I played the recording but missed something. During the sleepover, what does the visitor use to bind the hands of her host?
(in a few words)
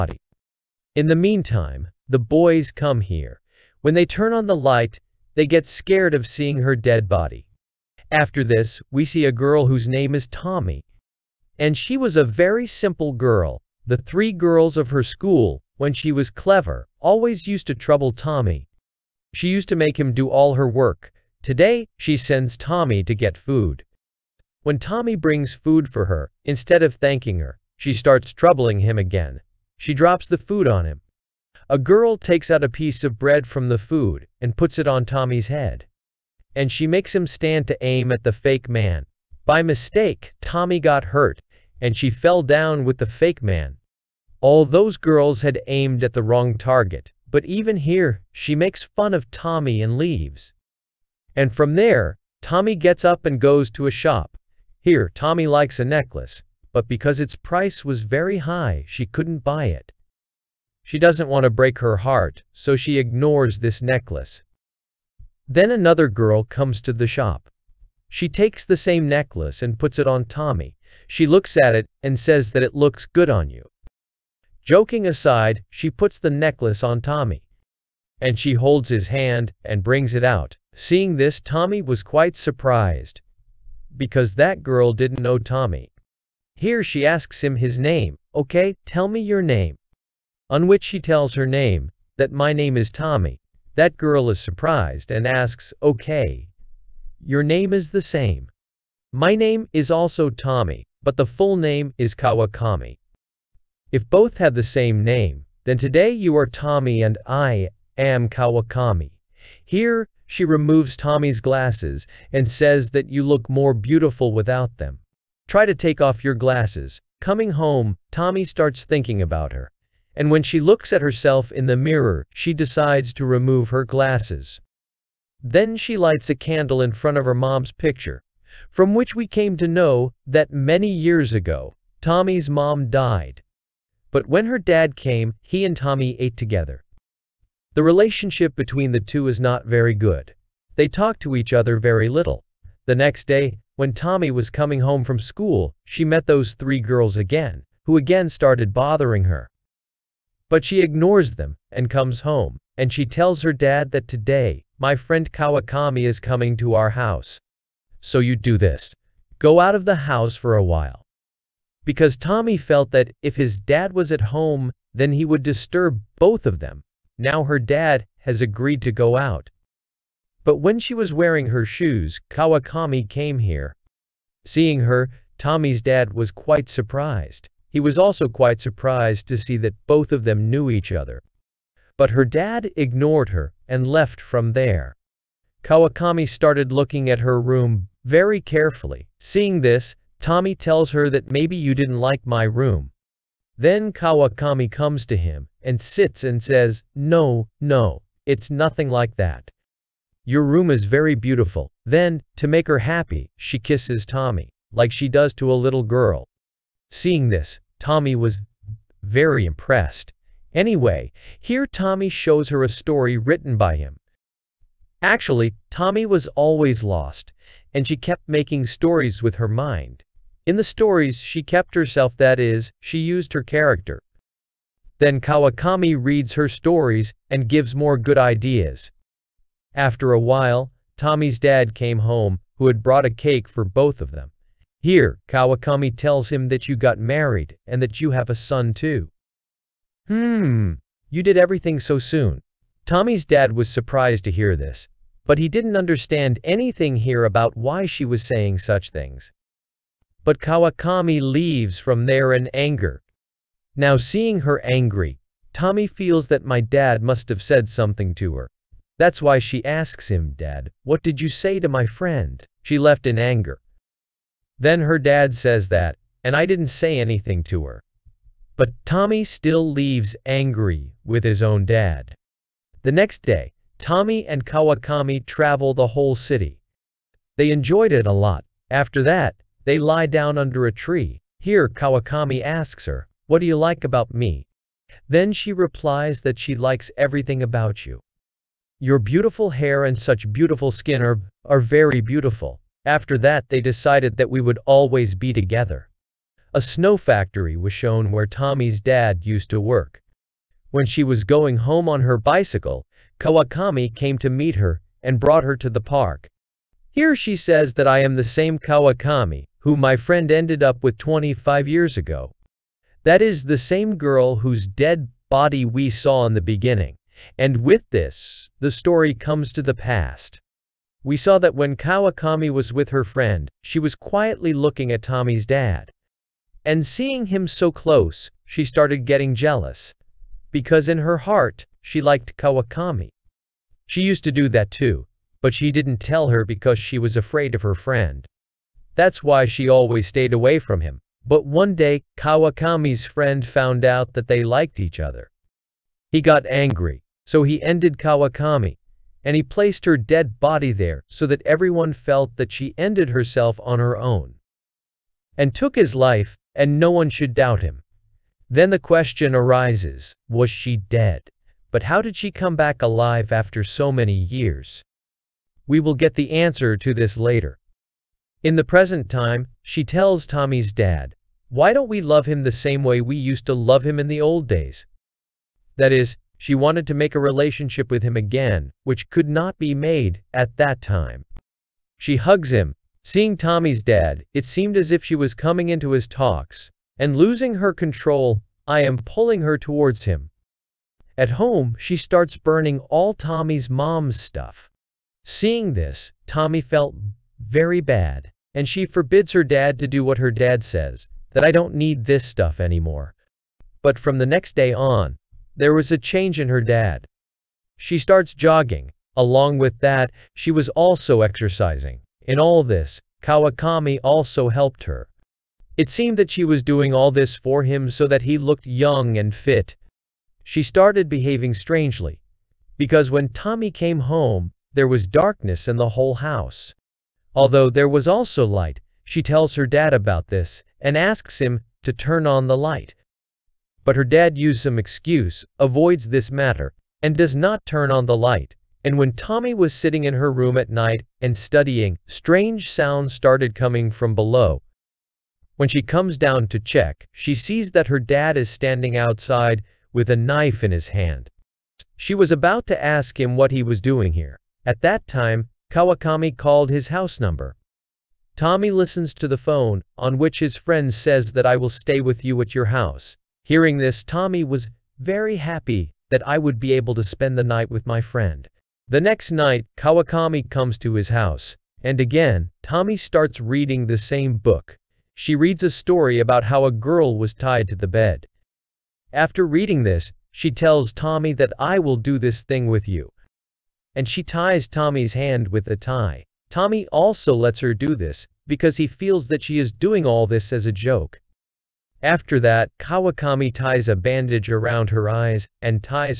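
A tie.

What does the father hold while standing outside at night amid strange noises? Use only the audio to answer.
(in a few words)
A knife.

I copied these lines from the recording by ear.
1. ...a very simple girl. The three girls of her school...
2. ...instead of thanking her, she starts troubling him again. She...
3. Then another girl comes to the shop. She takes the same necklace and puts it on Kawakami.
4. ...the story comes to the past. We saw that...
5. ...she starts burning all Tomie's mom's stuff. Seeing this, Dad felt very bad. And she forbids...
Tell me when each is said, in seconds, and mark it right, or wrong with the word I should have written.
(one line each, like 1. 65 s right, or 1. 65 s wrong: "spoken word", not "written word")
1. 12 s right
2. 26 s right
3. 65 s wrong: "Tomie", not "Kawakami"
4. 318 s right
5. 391 s wrong: "Tomie", not "Dad".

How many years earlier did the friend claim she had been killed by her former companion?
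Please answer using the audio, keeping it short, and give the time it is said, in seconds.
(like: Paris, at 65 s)
25, at 310 s.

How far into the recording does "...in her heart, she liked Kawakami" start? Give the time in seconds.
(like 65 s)
330 s.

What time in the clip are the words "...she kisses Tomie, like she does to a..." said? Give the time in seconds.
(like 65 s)
203 s.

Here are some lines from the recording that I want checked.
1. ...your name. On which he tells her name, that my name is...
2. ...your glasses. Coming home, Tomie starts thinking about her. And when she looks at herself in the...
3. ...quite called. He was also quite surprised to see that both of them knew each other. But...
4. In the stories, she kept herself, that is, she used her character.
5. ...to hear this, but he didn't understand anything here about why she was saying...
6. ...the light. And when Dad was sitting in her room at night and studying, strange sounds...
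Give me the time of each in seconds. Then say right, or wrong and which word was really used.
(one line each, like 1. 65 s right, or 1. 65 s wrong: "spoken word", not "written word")
1. 89 s right
2. 116 s right
3. 176 s wrong: "surprised", not "called"
4. 220 s right
5. 244 s right
6. 438 s wrong: "Tomie", not "Dad".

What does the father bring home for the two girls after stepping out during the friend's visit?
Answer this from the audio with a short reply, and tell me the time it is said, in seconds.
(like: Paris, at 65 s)
A cake, at 233 s.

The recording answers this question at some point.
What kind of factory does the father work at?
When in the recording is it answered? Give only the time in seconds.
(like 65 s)
296 s.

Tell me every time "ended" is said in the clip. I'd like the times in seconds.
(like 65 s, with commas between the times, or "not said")
310 s, 347 s, 352 s.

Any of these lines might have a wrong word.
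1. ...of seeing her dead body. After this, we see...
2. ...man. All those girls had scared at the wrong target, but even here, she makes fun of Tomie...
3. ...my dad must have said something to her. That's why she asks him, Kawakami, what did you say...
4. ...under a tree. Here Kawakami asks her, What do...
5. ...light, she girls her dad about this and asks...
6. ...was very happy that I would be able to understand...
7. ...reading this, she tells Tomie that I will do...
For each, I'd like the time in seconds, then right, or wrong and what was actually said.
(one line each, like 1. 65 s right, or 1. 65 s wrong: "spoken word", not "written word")
1. 6 s right
2. 43 s wrong: "aimed", not "scared"
3. 256 s wrong: "Dad", not "Kawakami"
4. 280 s right
5. 428 s wrong: "tells", not "girls"
6. 464 s wrong: "spend", not "understand"
7. 479 s right.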